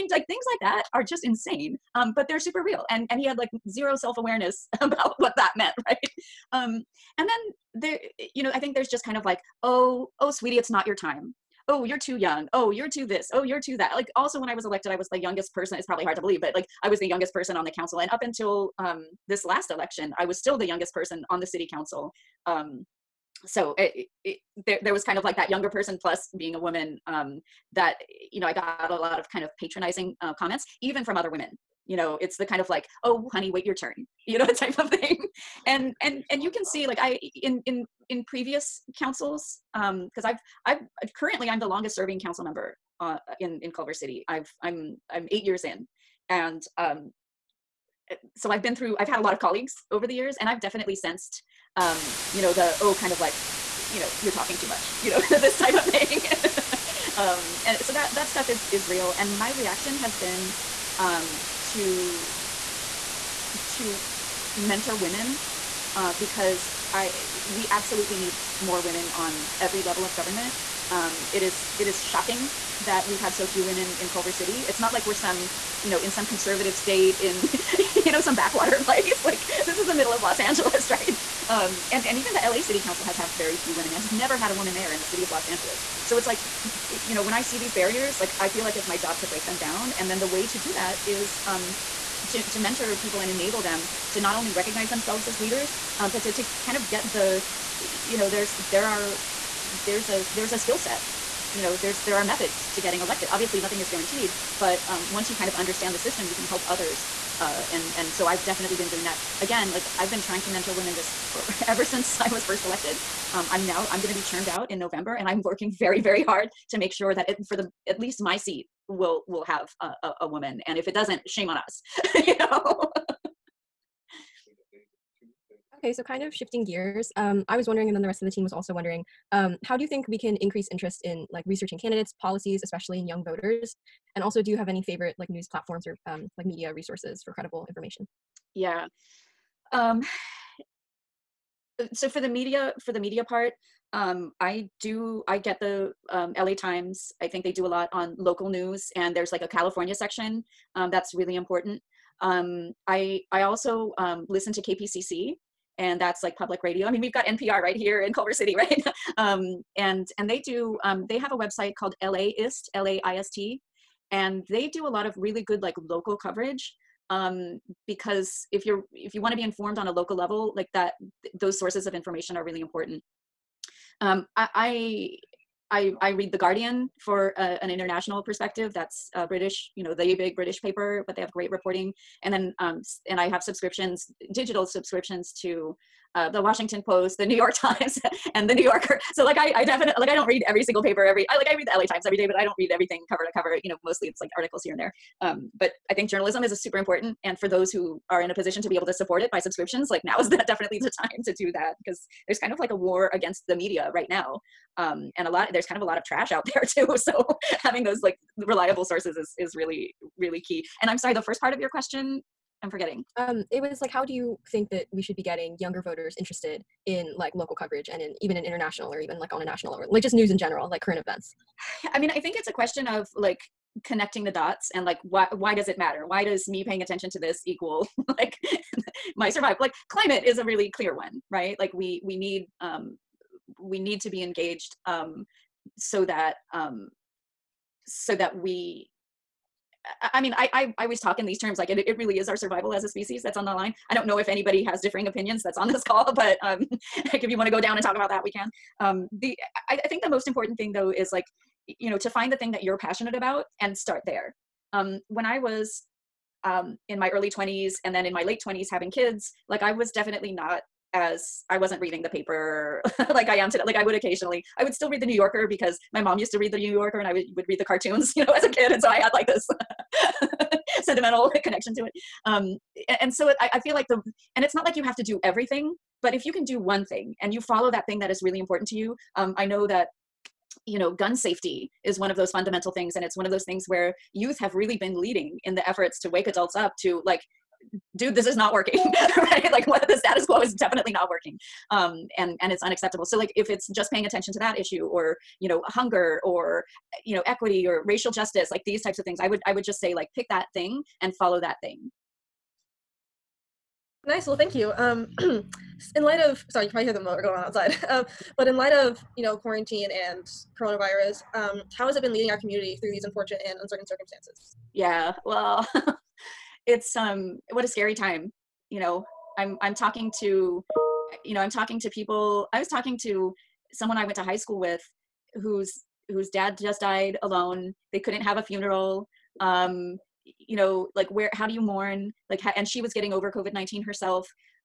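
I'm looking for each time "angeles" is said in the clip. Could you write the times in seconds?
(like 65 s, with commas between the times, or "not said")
80 s, 85 s.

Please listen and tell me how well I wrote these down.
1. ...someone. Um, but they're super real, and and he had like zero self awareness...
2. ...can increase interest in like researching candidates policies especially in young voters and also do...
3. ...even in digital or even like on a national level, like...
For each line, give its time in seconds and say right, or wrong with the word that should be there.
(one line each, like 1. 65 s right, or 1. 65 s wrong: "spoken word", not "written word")
1. 1 s wrong: "insane", not "someone"
2. 130 s right
3. 218 s wrong: "international", not "digital".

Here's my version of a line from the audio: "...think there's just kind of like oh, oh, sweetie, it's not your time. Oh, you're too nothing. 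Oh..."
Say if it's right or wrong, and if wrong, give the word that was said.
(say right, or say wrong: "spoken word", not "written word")
wrong: "young", not "nothing".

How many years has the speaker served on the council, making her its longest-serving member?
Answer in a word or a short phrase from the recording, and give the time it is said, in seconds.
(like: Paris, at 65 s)
8, at 45 s.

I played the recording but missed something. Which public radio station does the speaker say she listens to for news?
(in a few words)
KPCC.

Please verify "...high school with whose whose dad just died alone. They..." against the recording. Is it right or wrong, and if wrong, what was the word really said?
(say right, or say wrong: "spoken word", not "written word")
right.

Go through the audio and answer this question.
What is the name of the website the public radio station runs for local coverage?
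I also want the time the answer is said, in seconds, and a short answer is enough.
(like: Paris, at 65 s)
LAist, at 162 s.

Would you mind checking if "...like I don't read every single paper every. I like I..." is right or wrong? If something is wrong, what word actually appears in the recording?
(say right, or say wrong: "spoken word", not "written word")
right.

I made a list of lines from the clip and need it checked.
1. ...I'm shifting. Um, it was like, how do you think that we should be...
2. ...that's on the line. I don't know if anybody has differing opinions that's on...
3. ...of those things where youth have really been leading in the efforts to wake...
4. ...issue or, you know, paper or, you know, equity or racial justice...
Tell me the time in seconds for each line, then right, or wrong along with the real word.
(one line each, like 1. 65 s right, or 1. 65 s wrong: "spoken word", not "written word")
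1. 212 s wrong: "forgetting", not "shifting"
2. 243 s right
3. 283 s right
4. 294 s wrong: "hunger", not "paper".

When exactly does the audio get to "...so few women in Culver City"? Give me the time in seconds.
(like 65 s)
73 s.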